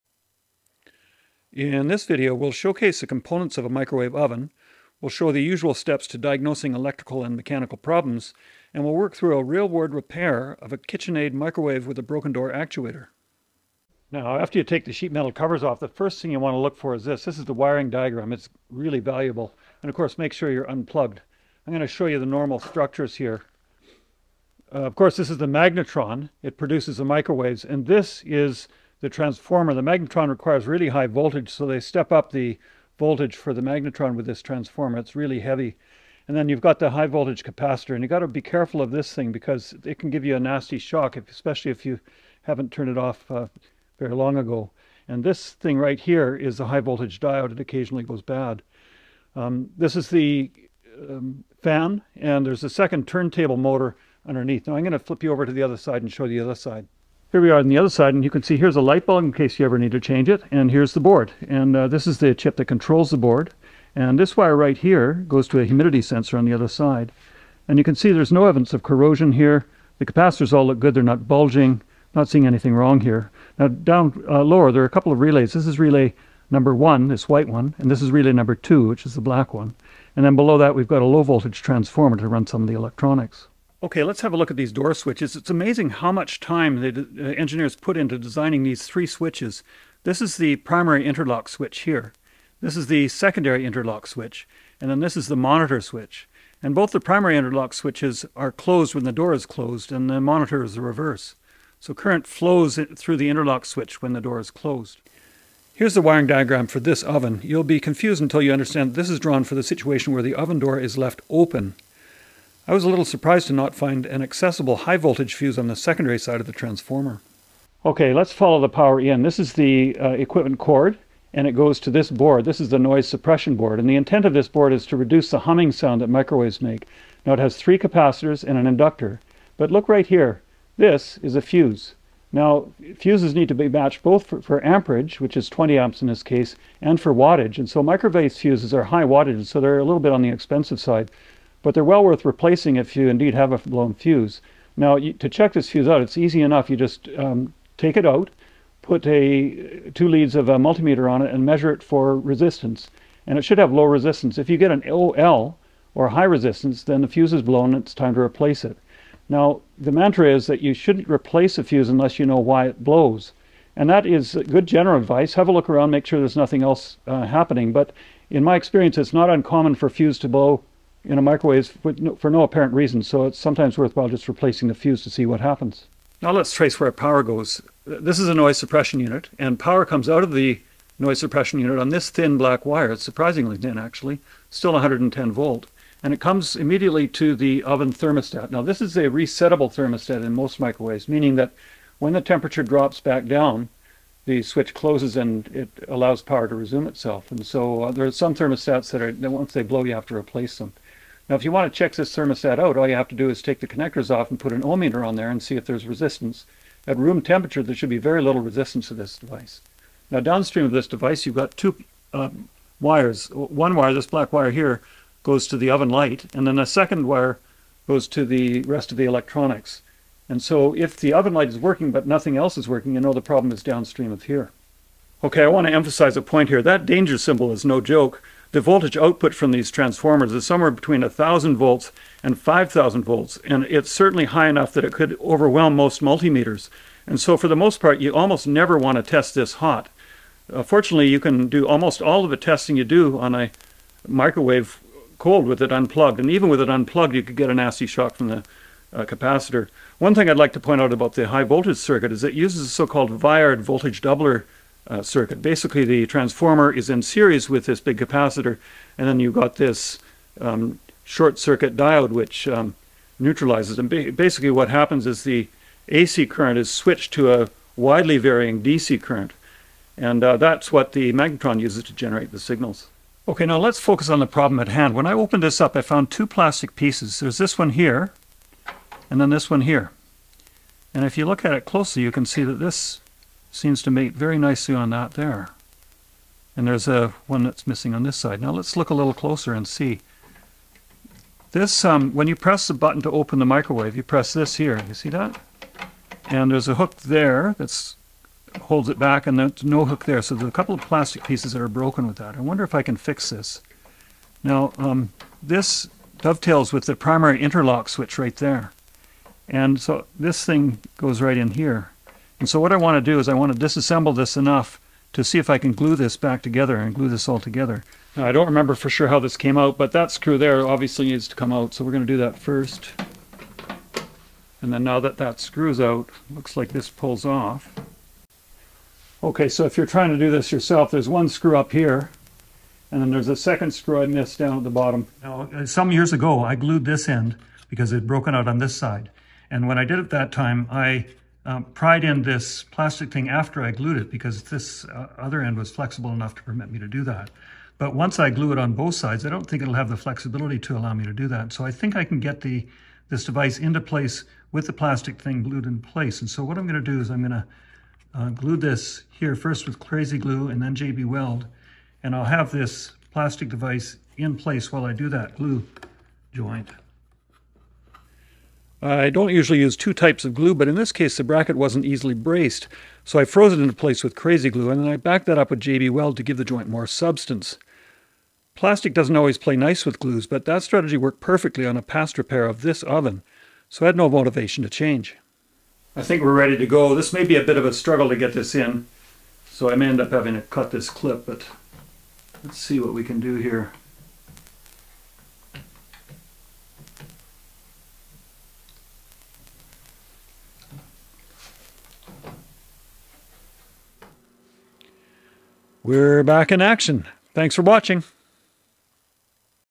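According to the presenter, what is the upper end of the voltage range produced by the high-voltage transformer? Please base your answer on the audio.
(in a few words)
5,000 volts.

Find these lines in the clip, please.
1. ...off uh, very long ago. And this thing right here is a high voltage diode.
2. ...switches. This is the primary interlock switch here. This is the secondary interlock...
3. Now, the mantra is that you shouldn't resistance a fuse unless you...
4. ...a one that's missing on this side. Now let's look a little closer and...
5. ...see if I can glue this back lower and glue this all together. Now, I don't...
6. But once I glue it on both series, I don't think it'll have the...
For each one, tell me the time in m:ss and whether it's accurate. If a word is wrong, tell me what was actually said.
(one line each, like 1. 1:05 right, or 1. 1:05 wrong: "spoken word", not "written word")
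1. 0:42 right
2. 1:29 right
3. 2:39 wrong: "replace", not "resistance"
4. 4:46 right
5. 5:15 wrong: "together", not "lower"
6. 5:47 wrong: "sides", not "series".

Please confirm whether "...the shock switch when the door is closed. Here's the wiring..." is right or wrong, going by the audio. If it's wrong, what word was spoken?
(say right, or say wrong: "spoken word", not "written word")
wrong: "interlock", not "shock".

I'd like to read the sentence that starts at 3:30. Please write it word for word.
Now, downstream of this device, you've got two um, wires.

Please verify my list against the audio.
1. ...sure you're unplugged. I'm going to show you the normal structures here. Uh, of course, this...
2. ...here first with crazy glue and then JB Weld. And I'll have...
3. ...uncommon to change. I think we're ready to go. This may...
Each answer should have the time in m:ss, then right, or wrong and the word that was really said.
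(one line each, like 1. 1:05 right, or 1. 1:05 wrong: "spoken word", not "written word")
1. 0:20 right
2. 5:59 right
3. 6:24 wrong: "motivation", not "uncommon".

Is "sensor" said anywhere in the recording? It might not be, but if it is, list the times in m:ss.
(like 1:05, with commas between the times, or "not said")
1:06.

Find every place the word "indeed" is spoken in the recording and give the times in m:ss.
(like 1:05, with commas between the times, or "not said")
2:23.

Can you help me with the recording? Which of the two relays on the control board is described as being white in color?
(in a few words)
relay number one.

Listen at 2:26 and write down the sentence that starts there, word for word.
You just um, take it out, put a two leads of a multimeter on it, and measure it for resistance.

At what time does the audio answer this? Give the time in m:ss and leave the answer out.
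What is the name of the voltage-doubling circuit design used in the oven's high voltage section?
4:13.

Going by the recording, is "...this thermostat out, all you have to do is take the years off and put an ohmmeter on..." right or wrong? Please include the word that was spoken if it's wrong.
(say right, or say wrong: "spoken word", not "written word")
wrong: "connectors", not "years".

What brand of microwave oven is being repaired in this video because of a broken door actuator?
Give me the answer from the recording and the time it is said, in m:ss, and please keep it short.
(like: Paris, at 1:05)
KitchenAid, at 0:10.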